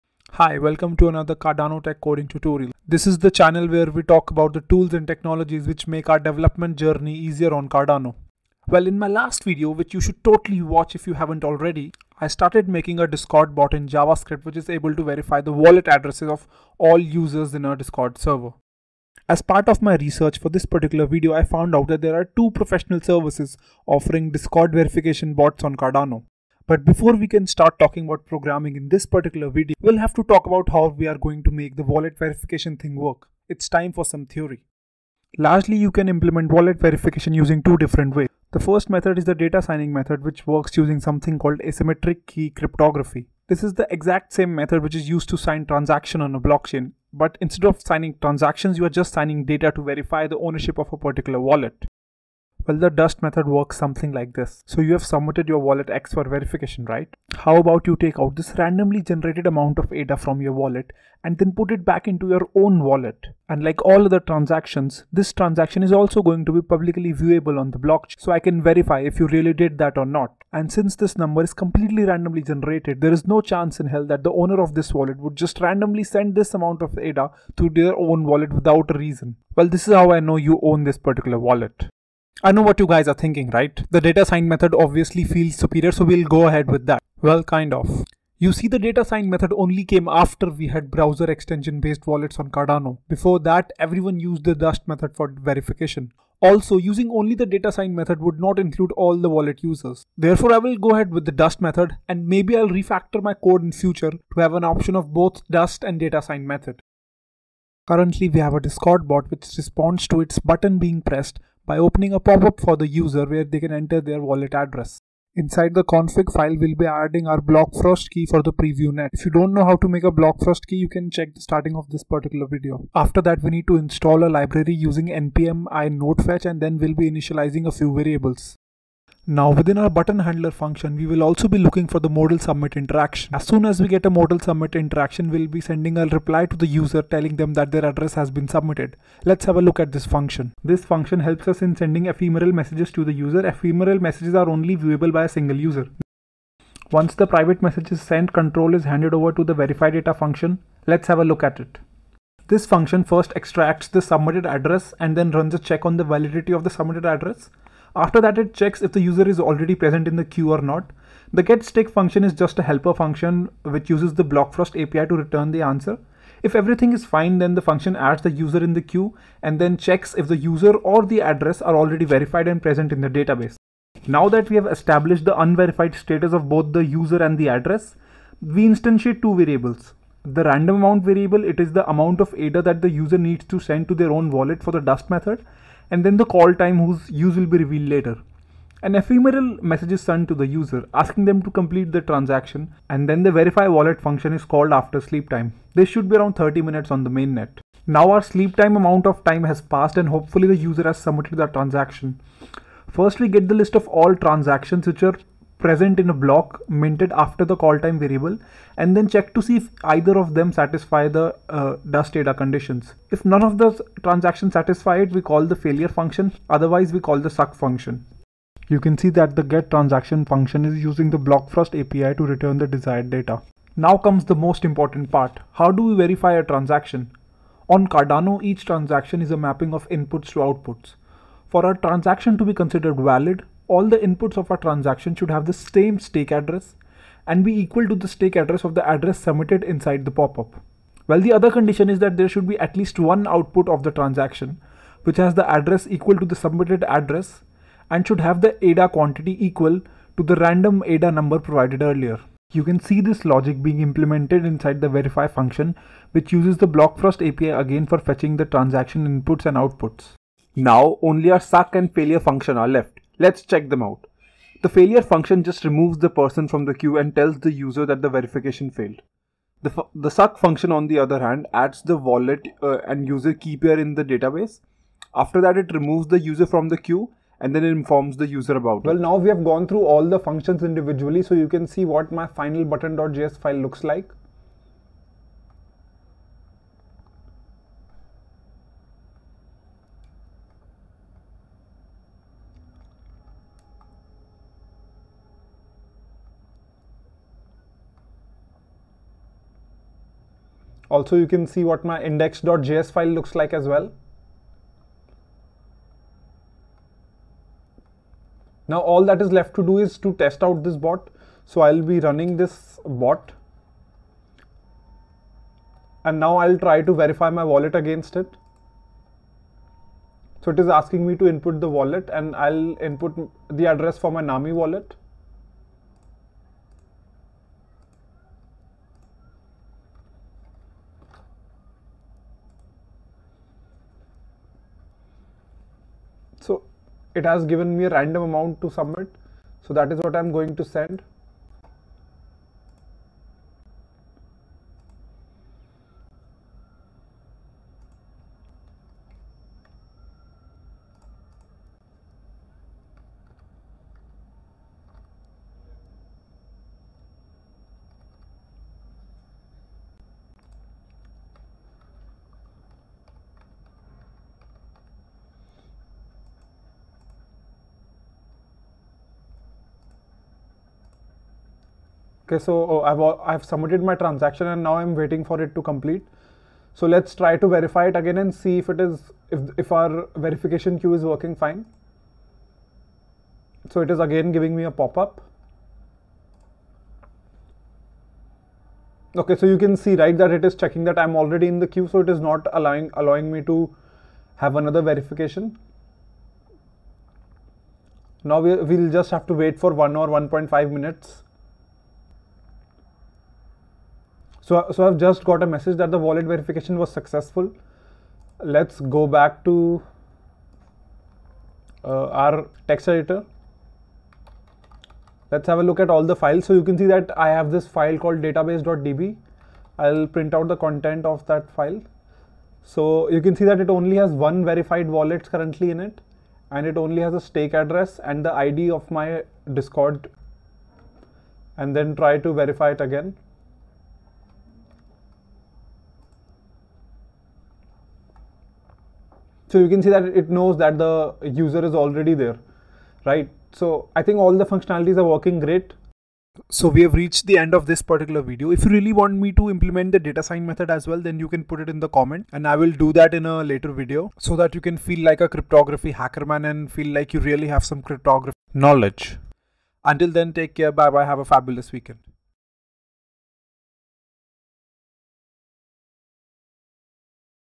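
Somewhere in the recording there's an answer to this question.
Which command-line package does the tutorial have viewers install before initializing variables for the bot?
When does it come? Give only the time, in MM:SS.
02:05.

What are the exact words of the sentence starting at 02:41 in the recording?
The getStick function is just a helper function which uses the Blockfrost API to return the answer.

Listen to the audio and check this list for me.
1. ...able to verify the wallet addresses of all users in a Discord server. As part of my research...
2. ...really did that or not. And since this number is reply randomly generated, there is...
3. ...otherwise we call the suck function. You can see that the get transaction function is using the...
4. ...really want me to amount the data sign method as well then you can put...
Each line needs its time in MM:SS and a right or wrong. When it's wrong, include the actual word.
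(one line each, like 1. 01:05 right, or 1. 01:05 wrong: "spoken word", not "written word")
1. 00:14 right
2. 01:09 wrong: "completely", not "reply"
3. 03:36 right
4. 07:28 wrong: "implement", not "amount".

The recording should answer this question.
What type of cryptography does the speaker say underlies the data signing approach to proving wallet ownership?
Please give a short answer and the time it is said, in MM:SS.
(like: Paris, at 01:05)
asymmetric key cryptography, at 00:41.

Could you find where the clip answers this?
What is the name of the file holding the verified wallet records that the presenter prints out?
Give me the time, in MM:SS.
06:58.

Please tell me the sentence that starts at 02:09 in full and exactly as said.
Now within our button handler function, we will also be looking for the modal submit interaction.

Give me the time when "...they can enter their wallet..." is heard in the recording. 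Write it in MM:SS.
01:53.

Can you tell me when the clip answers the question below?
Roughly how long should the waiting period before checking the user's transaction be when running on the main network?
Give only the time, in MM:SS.
03:16.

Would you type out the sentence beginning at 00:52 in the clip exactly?
Well, the dust method works something like this.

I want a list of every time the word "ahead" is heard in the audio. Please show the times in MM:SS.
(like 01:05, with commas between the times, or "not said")
01:26, 01:40.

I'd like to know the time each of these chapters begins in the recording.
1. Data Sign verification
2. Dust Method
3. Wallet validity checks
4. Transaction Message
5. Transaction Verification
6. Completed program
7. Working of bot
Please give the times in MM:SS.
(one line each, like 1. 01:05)
1. 00:38
2. 00:53
3. 02:00
4. 03:00
5. 03:45
6. 04:39
7. 05:10.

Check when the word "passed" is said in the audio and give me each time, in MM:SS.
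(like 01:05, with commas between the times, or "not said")
03:19.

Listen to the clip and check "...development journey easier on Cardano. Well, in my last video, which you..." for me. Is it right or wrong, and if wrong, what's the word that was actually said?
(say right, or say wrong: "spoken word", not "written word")
right.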